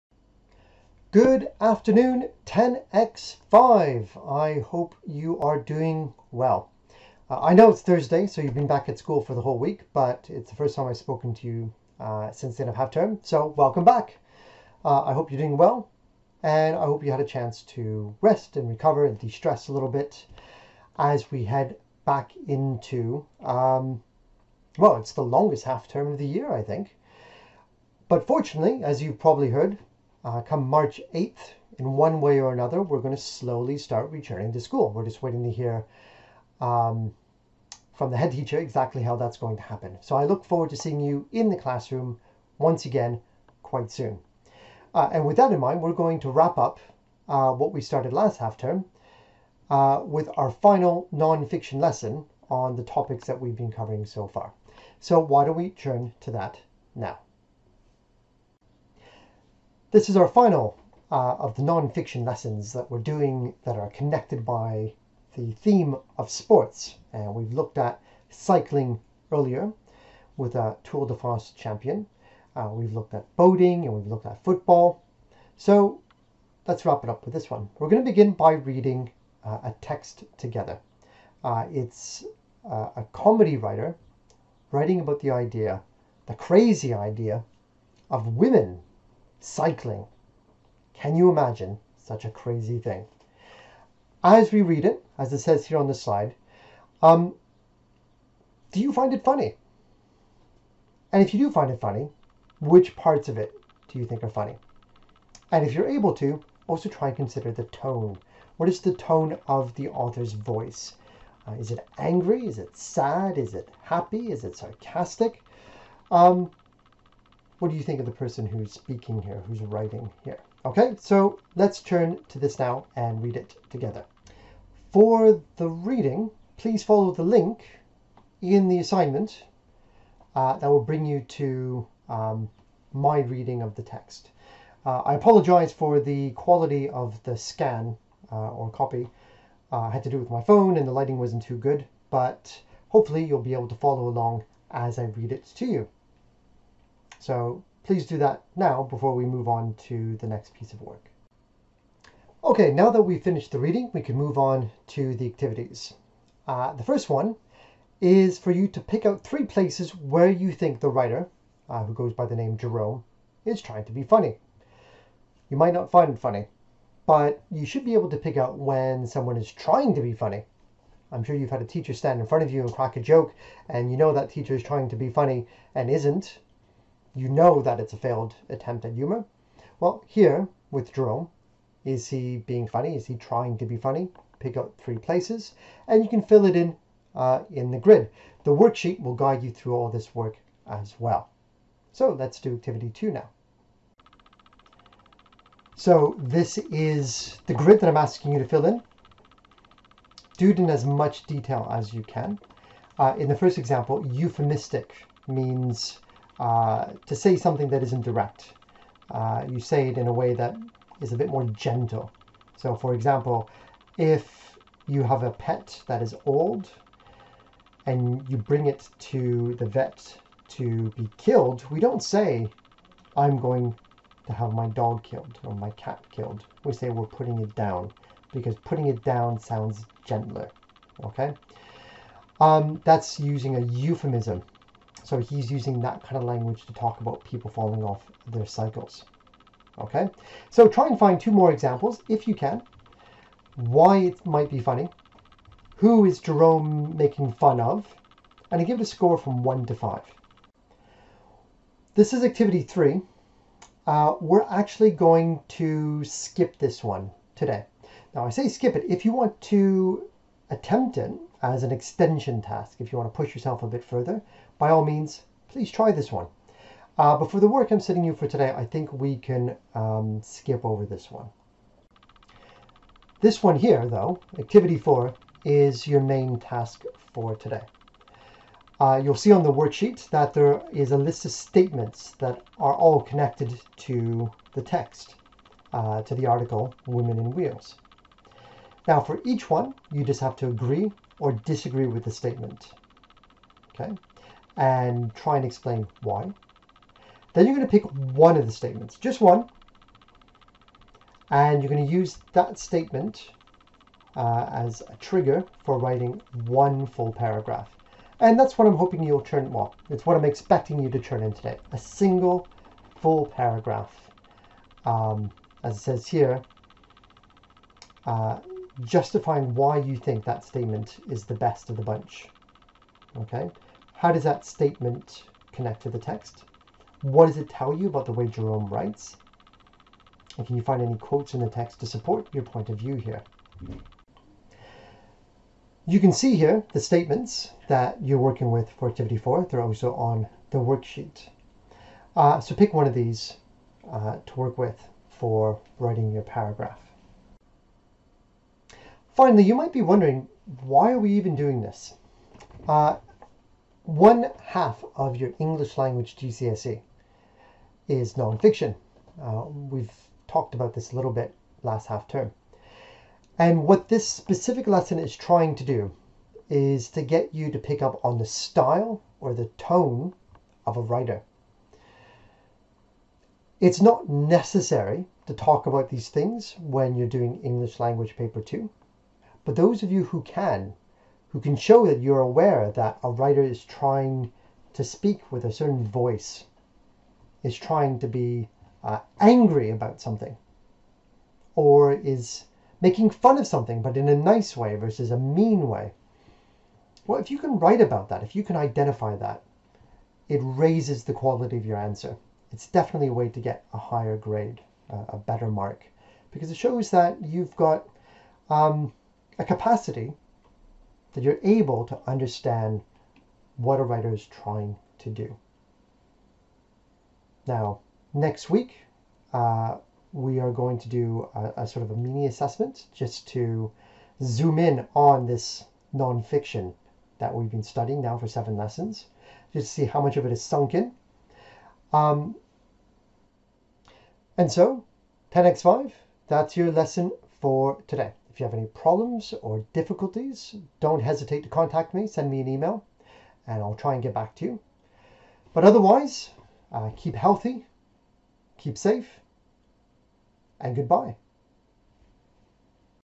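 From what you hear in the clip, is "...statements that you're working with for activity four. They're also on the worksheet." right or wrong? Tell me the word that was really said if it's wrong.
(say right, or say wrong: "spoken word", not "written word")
right.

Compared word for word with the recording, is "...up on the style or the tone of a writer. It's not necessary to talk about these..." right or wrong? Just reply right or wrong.
right.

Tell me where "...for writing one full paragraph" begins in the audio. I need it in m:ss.
5:05.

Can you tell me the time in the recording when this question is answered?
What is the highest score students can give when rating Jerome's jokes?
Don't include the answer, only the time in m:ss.
4:09.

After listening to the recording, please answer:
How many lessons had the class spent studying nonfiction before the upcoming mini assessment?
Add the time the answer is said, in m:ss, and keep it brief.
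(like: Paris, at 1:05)
7, at 7:08.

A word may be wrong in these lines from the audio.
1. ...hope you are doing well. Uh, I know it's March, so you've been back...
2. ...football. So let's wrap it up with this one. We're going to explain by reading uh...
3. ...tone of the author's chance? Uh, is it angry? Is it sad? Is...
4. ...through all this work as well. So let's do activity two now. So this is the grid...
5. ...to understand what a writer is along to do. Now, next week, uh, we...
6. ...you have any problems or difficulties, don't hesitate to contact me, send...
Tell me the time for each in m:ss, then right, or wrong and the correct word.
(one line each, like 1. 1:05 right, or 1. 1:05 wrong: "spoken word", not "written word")
1. 0:04 wrong: "Thursday", not "March"
2. 1:14 wrong: "begin", not "explain"
3. 1:48 wrong: "voice", not "chance"
4. 3:09 right
5. 6:51 wrong: "trying", not "along"
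6. 7:18 right.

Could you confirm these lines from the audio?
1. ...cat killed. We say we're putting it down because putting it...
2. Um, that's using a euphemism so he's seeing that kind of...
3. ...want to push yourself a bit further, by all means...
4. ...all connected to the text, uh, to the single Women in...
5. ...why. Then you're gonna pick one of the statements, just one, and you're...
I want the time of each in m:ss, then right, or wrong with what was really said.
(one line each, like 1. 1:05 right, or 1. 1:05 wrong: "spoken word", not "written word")
1. 3:45 right
2. 3:52 wrong: "using", not "seeing"
3. 4:22 right
4. 4:42 wrong: "article", not "single"
5. 4:56 right.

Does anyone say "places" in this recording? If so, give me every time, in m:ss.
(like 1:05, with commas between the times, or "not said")
2:39, 3:04.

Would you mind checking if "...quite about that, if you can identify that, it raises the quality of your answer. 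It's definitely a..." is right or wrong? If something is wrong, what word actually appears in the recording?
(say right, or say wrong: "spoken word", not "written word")
wrong: "write", not "quite".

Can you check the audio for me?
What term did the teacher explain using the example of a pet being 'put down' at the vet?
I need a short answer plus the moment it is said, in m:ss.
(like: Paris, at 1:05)
euphemistic, at 3:24.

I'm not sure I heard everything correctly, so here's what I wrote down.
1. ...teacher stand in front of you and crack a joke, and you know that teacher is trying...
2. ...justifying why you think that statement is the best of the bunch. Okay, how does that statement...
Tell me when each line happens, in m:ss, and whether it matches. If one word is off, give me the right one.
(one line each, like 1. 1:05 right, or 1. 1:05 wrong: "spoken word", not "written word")
1. 2:51 right
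2. 5:18 right.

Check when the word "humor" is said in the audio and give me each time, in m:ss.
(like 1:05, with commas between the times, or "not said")
2:58.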